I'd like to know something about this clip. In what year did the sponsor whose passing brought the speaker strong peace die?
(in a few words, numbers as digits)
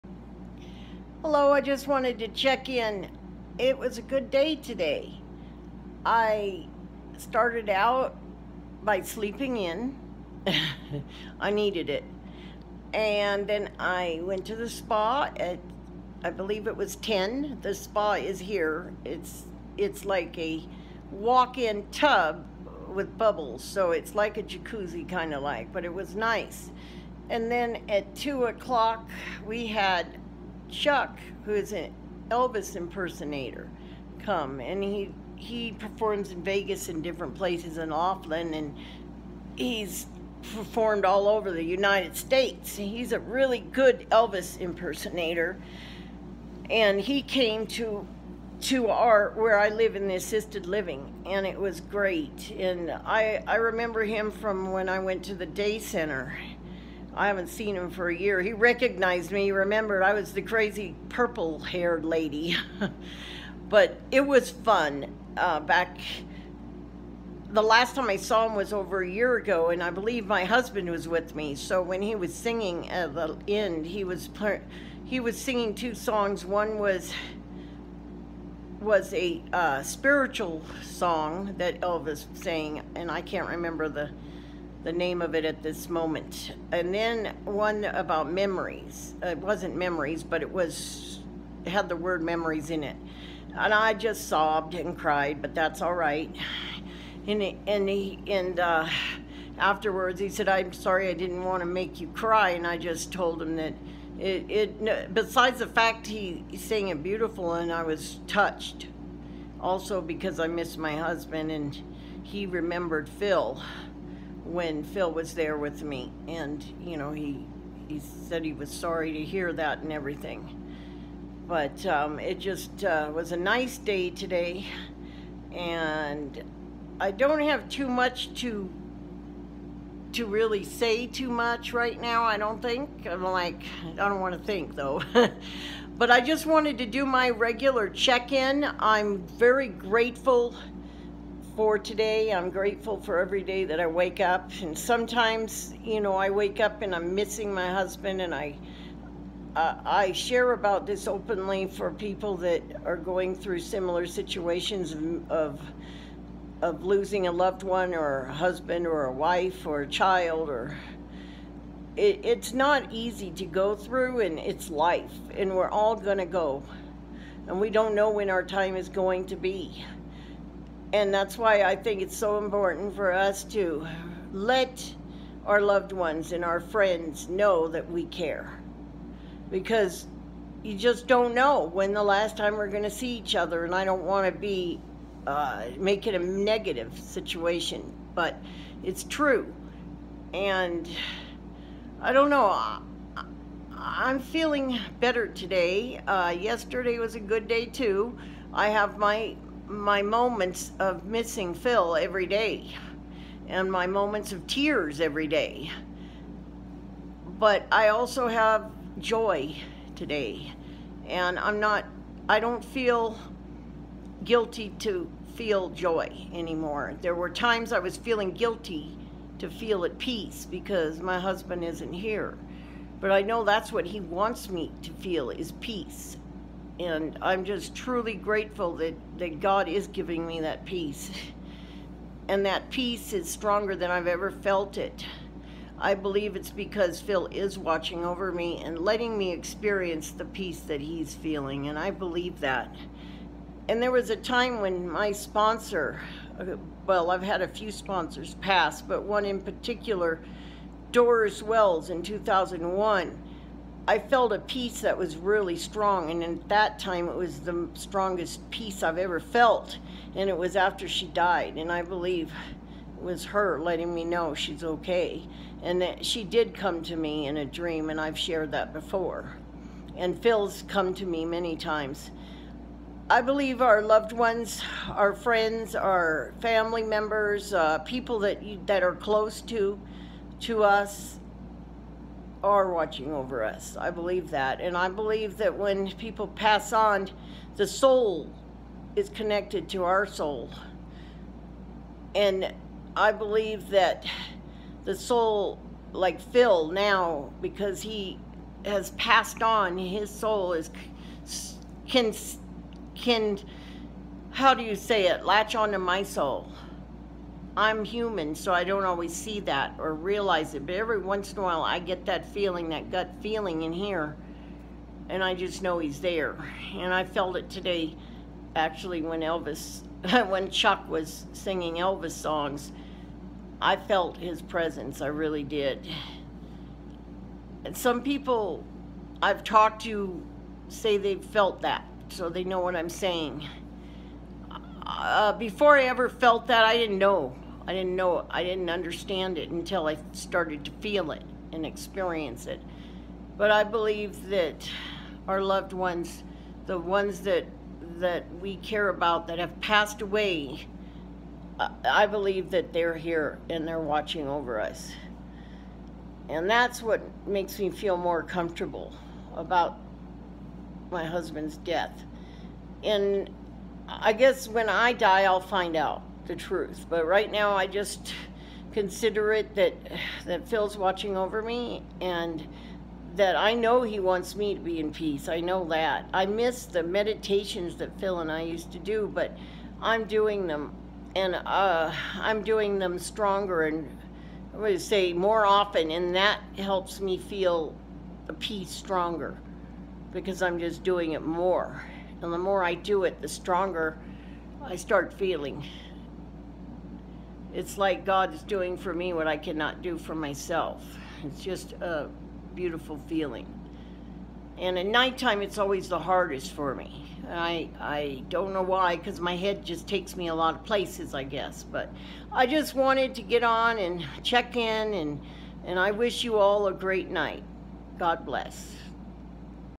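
2001.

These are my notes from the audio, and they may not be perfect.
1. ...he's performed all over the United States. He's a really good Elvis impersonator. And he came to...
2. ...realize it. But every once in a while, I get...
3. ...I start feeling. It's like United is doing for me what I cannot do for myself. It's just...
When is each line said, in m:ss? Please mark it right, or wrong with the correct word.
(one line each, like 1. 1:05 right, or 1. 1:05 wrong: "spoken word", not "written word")
1. 0:39 right
2. 5:09 right
3. 6:34 wrong: "God", not "United".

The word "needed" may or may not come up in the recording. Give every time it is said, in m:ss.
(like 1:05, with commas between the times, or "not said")
0:11.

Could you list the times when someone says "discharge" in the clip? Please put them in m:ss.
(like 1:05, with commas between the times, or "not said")
not said.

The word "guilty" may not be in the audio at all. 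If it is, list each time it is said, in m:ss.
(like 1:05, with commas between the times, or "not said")
3:34, 3:38.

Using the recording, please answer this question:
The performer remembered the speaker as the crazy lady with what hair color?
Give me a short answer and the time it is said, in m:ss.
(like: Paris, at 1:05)
Purple, at 1:01.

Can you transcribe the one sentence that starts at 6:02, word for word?
And I guess when I die, I'll find out the truth.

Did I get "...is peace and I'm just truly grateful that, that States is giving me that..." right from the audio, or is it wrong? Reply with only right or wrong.
wrong.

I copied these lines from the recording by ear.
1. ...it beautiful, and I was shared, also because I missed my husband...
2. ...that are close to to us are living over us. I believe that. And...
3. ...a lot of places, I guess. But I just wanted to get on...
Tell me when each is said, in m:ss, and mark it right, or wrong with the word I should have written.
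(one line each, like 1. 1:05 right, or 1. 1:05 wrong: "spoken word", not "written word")
1. 1:46 wrong: "touched", not "shared"
2. 4:38 wrong: "watching", not "living"
3. 6:50 right.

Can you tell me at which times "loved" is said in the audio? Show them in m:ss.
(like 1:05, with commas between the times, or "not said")
2:37, 2:55, 4:33, 5:45.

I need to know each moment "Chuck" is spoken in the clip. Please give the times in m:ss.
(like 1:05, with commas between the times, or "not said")
0:30, 5:20.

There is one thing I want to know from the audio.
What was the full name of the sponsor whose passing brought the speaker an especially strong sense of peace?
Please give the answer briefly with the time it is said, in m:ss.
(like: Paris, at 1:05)
Doris Wells, at 4:10.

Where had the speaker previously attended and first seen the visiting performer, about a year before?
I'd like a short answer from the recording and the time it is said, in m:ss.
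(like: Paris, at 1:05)
The day center, at 0:55.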